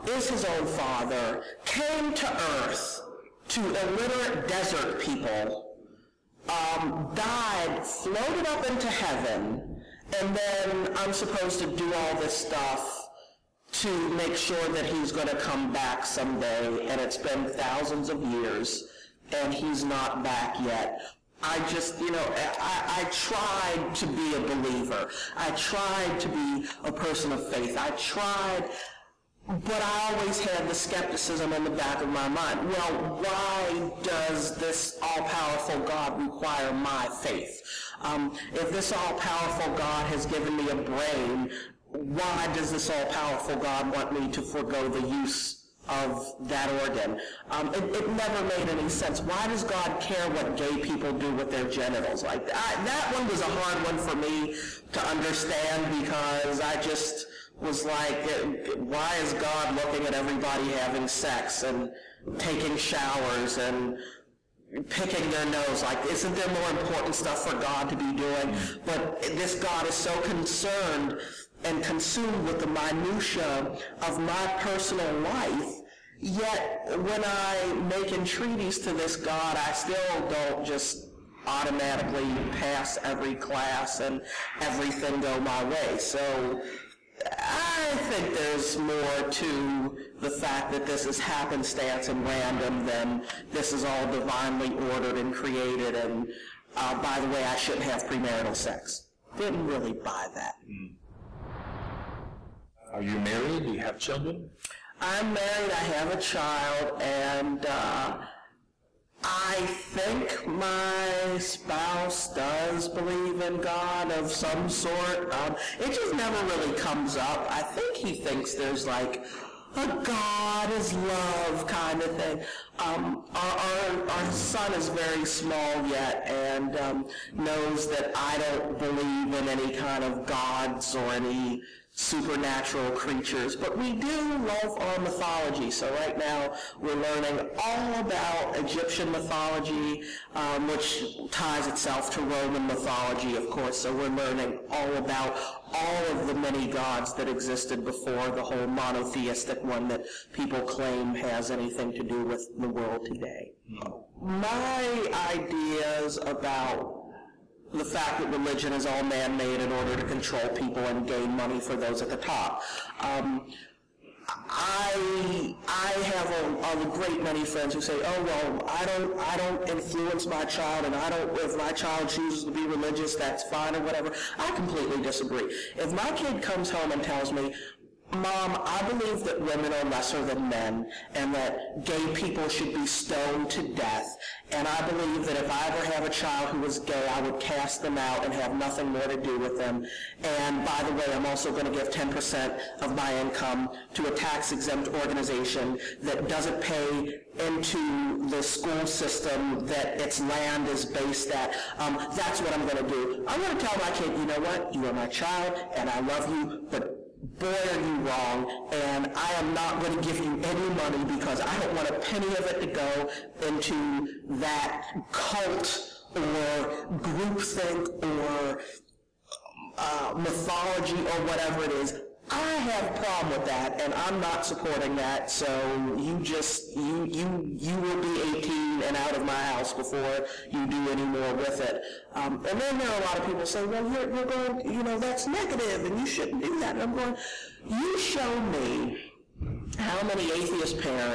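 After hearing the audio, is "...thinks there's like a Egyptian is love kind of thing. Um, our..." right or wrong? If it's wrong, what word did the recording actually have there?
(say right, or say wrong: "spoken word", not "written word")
wrong: "God", not "Egyptian".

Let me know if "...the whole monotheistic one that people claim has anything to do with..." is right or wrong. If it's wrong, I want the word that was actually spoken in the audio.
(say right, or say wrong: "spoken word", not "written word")
right.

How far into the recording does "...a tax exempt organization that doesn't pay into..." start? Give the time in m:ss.
3:14.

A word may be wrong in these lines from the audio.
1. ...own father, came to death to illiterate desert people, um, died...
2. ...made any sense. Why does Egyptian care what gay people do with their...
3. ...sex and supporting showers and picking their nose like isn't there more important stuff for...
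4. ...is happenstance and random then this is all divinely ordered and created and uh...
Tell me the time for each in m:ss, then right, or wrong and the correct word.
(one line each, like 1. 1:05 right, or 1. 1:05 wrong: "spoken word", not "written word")
1. 0:00 wrong: "earth", not "death"
2. 0:48 wrong: "God", not "Egyptian"
3. 1:01 wrong: "taking", not "supporting"
4. 1:31 right.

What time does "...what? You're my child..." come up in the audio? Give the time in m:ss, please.
3:24.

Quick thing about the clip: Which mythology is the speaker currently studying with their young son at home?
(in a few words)
Egyptian mythology.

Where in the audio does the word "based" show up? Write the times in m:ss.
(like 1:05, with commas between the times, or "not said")
3:20.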